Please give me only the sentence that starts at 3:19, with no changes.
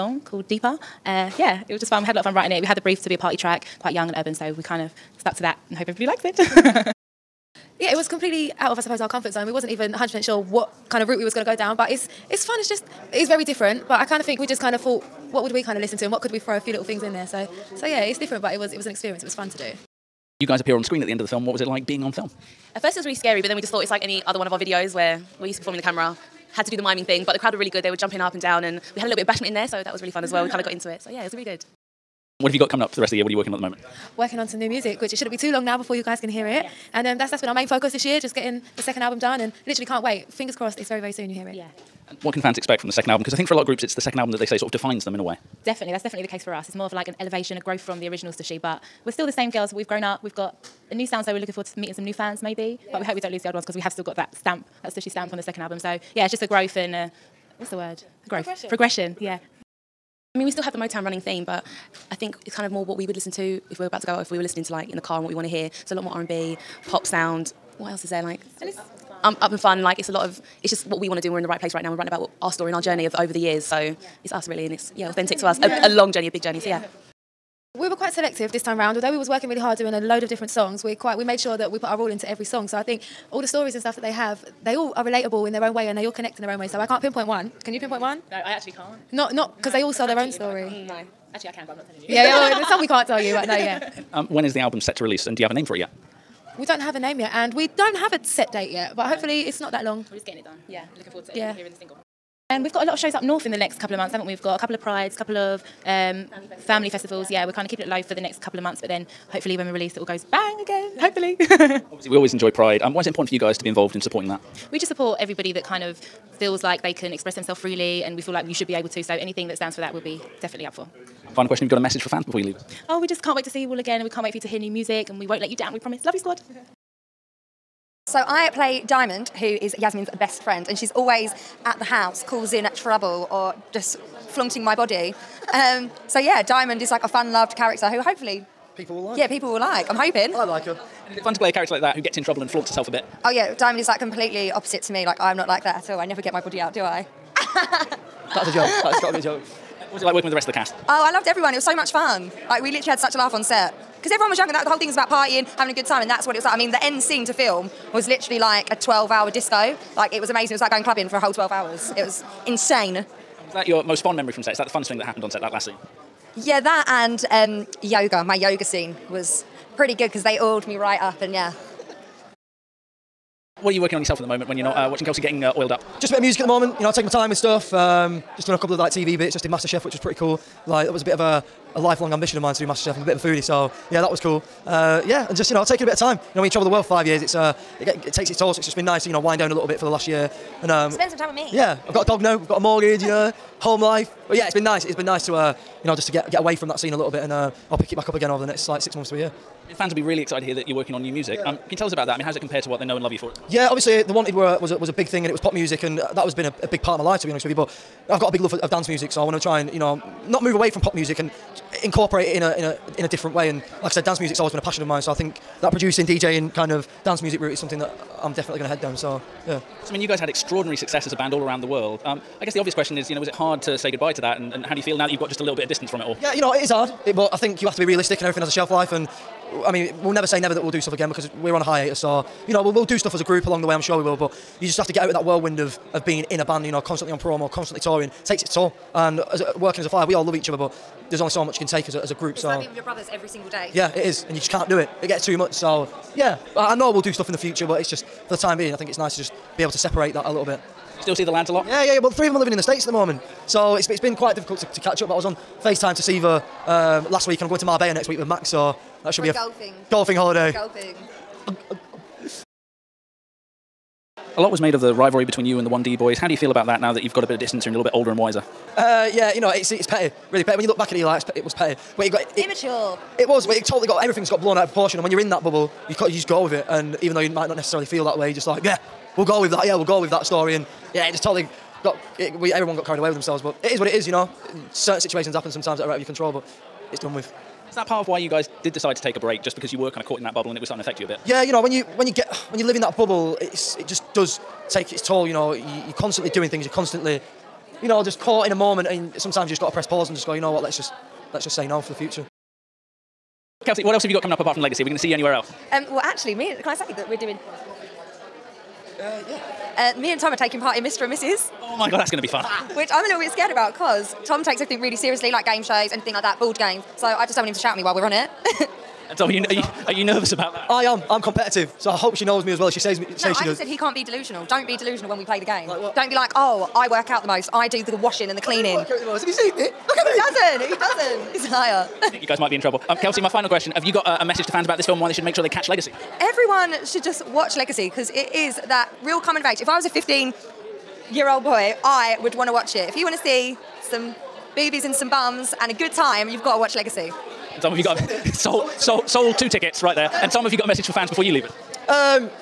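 I mean, fans will be really excited to hear that you're working on new music.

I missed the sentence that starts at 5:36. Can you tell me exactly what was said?
Everyone should just watch Legacy because it is that real coming of age.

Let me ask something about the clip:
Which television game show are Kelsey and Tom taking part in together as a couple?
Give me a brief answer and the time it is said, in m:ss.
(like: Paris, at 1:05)
Mr. and Mrs., at 5:10.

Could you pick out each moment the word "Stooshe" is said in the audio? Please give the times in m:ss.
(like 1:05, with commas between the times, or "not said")
0:48, 0:54.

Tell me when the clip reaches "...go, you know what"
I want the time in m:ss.
5:00.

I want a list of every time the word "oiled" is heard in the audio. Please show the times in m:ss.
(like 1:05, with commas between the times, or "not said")
2:50, 2:55.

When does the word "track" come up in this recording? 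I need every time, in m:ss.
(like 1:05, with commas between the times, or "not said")
0:03.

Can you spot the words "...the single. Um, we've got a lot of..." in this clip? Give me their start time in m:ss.
1:41.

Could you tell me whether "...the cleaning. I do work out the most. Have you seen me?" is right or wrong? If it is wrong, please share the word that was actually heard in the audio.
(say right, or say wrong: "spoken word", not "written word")
right.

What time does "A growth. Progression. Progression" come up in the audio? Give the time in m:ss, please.
0:58.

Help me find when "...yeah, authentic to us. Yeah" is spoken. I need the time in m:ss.
1:14.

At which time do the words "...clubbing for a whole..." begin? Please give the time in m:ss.
2:40.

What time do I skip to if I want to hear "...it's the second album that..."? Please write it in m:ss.
0:43.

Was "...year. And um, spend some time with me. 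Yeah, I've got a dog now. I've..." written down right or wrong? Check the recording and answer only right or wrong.
right.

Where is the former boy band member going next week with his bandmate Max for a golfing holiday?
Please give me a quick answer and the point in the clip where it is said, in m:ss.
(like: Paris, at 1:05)
Marbella, at 4:17.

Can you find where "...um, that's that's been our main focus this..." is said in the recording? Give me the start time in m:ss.
0:37.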